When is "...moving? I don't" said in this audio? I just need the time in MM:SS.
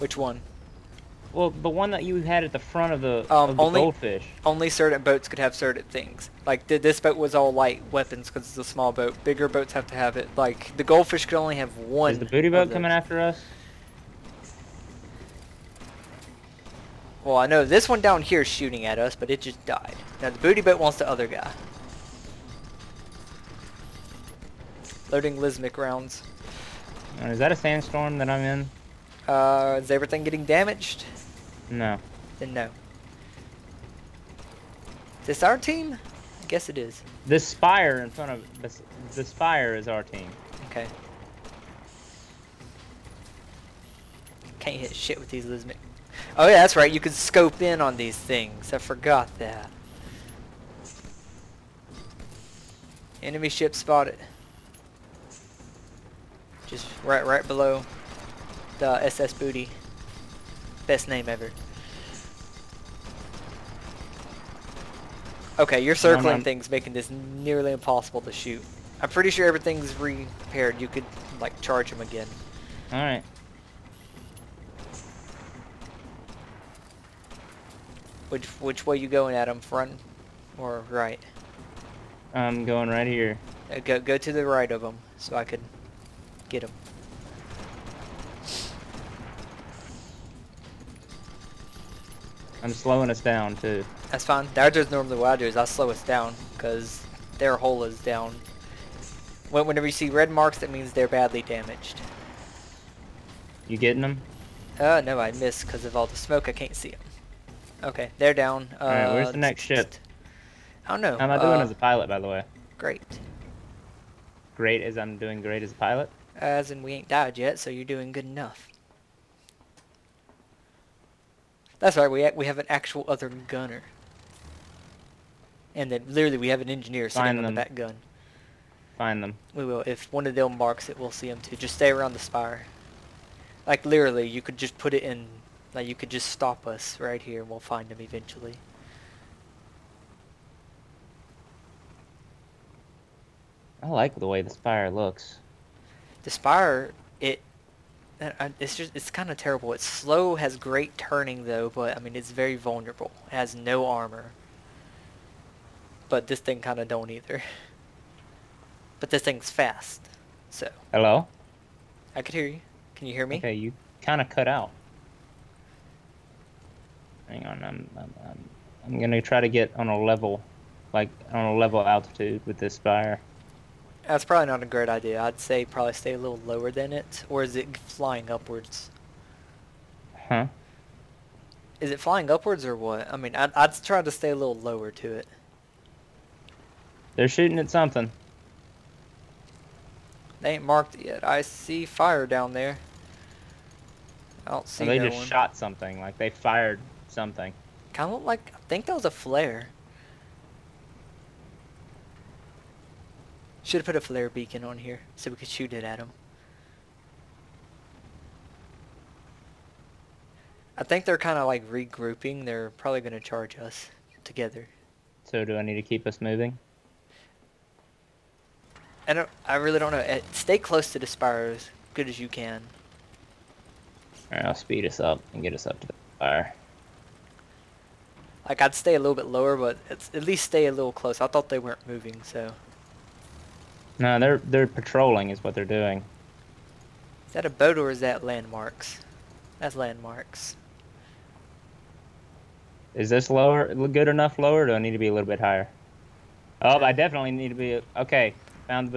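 03:36.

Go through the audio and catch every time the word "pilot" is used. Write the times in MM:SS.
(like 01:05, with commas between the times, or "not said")
01:51, 01:55.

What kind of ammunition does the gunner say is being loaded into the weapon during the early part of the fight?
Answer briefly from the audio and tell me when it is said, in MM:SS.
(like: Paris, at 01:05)
Lesmok rounds, at 00:25.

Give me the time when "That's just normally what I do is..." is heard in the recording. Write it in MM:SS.
01:34.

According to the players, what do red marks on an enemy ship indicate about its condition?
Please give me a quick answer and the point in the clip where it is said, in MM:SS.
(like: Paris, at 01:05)
badly damaged, at 01:41.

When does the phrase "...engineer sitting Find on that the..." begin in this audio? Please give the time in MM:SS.
02:06.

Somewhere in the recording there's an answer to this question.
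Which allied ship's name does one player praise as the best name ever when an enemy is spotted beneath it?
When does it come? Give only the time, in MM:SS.
00:59.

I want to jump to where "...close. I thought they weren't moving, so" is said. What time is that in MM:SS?
03:50.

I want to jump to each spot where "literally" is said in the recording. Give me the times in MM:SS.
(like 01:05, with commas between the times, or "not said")
02:06, 02:13.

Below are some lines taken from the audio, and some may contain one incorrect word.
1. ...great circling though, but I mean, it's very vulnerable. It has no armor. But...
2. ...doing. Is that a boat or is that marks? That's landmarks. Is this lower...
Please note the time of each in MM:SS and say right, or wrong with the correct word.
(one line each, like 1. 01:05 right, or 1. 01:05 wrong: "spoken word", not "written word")
1. 02:30 wrong: "turning", not "circling"
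2. 03:55 wrong: "landmarks", not "marks".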